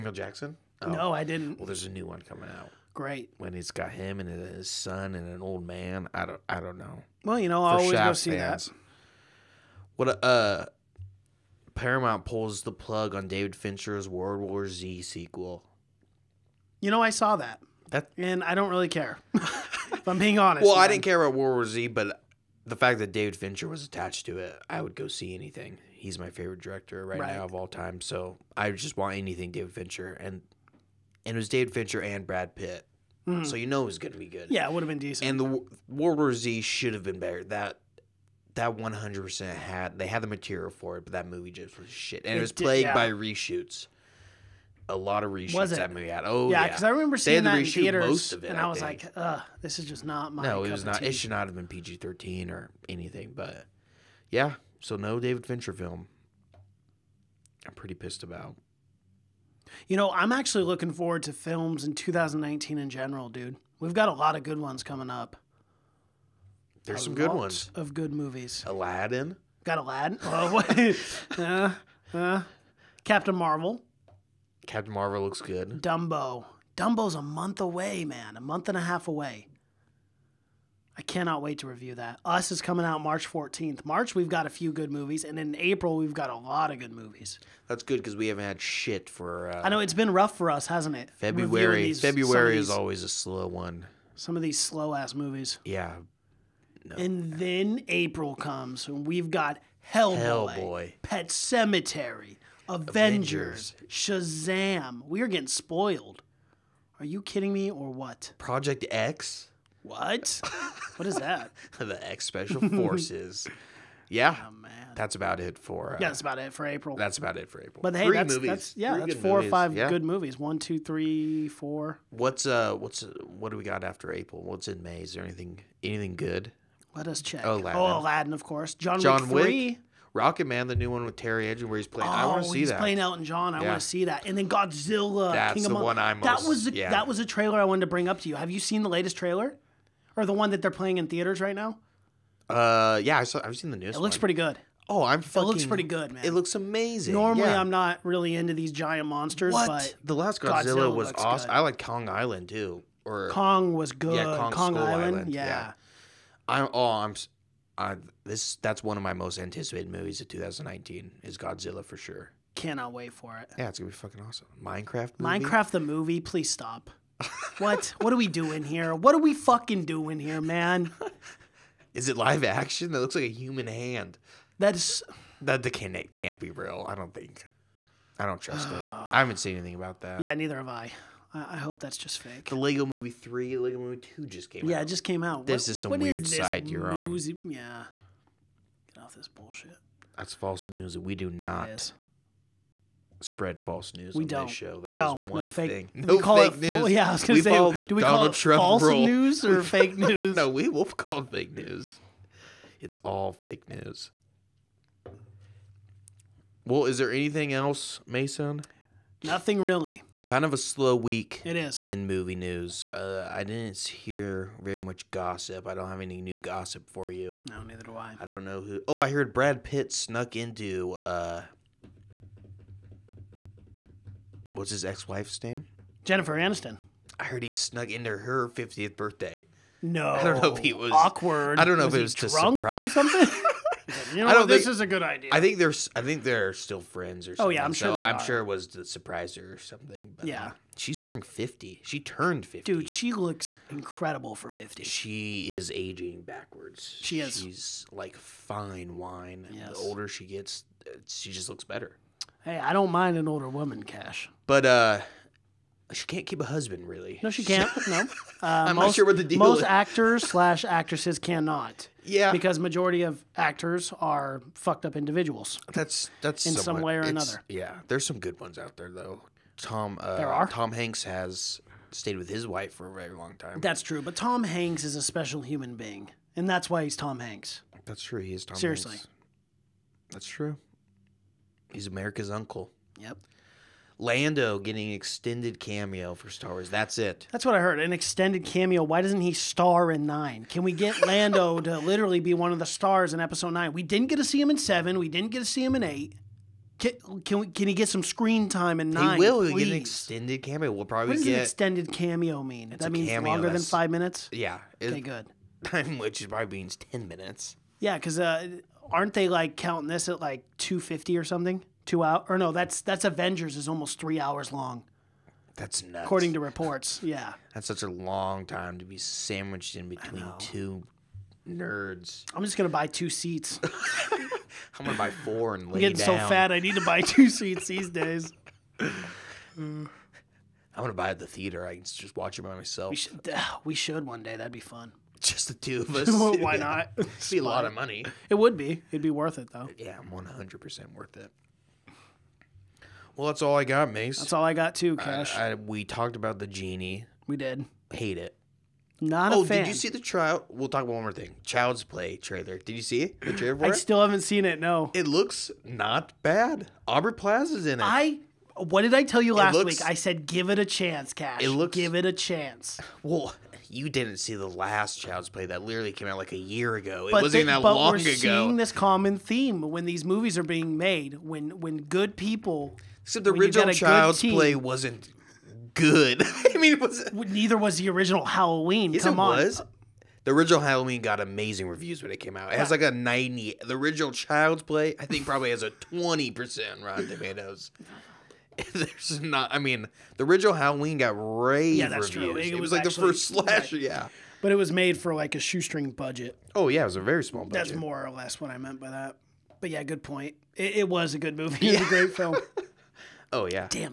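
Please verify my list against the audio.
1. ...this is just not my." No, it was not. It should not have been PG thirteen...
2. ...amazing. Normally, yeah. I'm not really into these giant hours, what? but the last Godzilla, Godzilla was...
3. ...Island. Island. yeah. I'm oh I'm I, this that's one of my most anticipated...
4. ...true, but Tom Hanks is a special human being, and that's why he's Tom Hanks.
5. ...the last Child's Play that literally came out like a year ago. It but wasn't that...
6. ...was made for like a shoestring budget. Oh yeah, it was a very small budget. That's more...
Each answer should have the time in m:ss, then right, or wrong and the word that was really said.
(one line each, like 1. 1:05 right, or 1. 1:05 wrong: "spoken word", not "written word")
1. 0:49 right
2. 2:26 wrong: "monsters", not "hours"
3. 2:34 right
4. 4:33 right
5. 6:04 right
6. 6:34 right.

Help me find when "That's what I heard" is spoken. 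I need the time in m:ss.
4:47.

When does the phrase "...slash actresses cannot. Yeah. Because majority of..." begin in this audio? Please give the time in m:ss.
4:20.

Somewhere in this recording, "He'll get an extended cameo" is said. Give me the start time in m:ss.
4:59.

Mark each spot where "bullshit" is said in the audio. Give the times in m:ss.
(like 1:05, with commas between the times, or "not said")
3:09.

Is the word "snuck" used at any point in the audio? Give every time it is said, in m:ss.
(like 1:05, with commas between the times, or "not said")
3:39, 3:47.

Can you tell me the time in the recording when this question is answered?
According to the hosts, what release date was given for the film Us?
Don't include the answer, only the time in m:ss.
1:23.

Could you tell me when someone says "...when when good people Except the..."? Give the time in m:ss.
6:11.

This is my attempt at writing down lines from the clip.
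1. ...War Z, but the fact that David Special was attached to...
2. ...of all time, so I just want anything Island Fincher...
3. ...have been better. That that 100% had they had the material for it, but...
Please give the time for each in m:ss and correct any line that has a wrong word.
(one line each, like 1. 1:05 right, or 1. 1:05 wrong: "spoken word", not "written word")
1. 0:21 wrong: "Fincher", not "Special"
2. 0:27 wrong: "David", not "Island"
3. 0:36 right.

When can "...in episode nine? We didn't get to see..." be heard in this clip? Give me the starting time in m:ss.
4:53.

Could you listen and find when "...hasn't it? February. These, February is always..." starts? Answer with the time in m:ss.
1:30.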